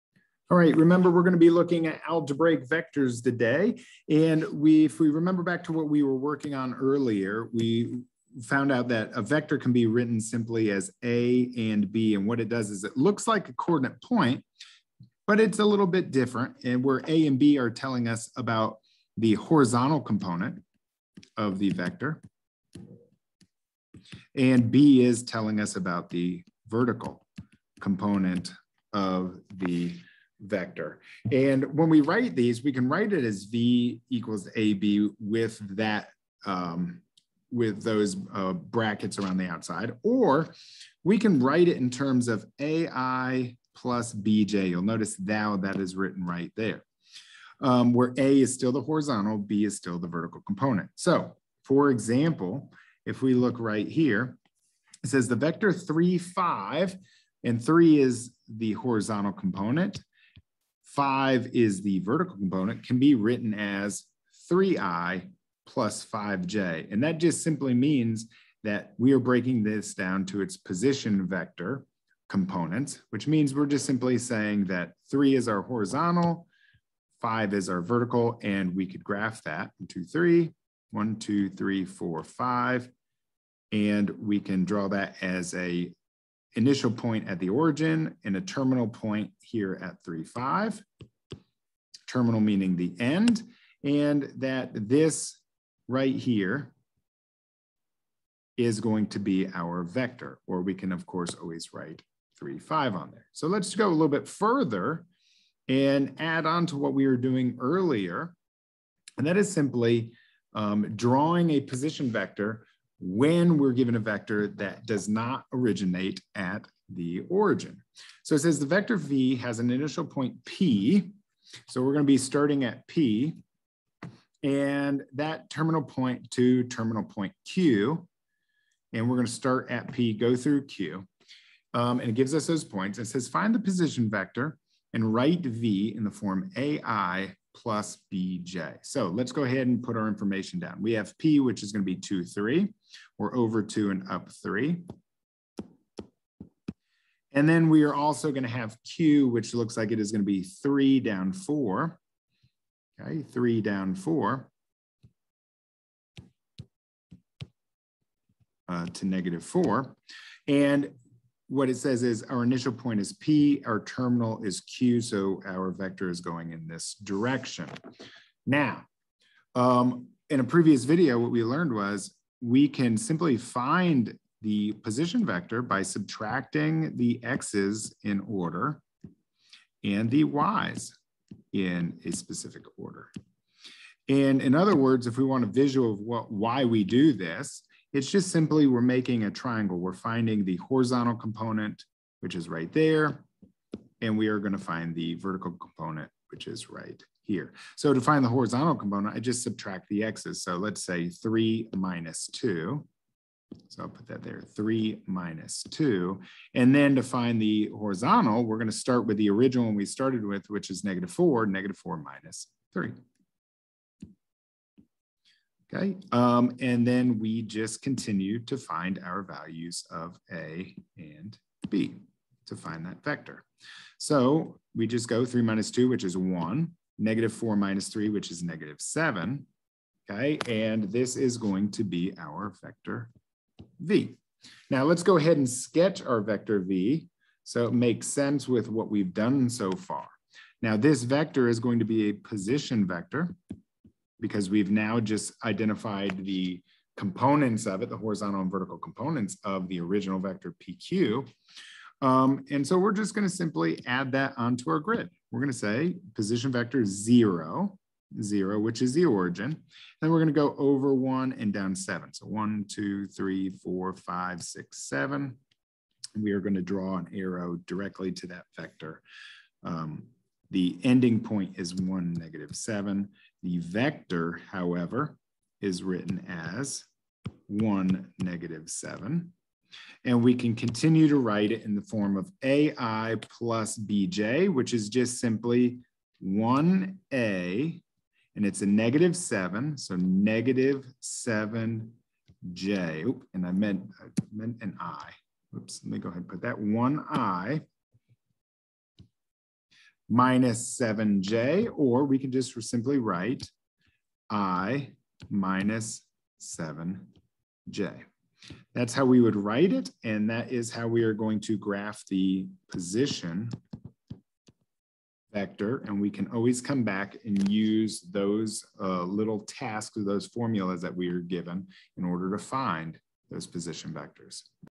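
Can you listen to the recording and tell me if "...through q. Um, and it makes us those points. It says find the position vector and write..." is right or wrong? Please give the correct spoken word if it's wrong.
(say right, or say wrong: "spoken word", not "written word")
wrong: "gives", not "makes".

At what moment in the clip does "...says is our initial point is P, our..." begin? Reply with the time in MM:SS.
02:41.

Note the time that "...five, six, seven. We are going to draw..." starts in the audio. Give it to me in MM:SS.
04:23.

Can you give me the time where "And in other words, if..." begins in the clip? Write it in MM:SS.
03:04.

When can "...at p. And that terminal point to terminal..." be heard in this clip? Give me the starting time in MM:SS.
02:02.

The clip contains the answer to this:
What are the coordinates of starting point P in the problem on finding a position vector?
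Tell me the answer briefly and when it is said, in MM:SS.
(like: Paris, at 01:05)
(2, 3), at 02:21.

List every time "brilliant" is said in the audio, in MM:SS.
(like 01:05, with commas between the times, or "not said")
not said.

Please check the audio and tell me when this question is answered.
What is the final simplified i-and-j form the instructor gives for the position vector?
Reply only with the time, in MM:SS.
05:04.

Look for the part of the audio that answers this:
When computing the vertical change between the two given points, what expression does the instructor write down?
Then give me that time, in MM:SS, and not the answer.
03:31.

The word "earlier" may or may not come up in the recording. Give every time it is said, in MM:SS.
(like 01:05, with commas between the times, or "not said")
00:06, 01:47.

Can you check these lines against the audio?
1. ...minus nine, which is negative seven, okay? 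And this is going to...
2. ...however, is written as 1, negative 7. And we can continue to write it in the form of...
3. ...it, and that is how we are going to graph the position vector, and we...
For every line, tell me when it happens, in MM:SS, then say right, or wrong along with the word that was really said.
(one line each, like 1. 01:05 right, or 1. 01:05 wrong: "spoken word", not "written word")
1. 03:47 wrong: "three", not "nine"
2. 04:34 right
3. 05:09 right.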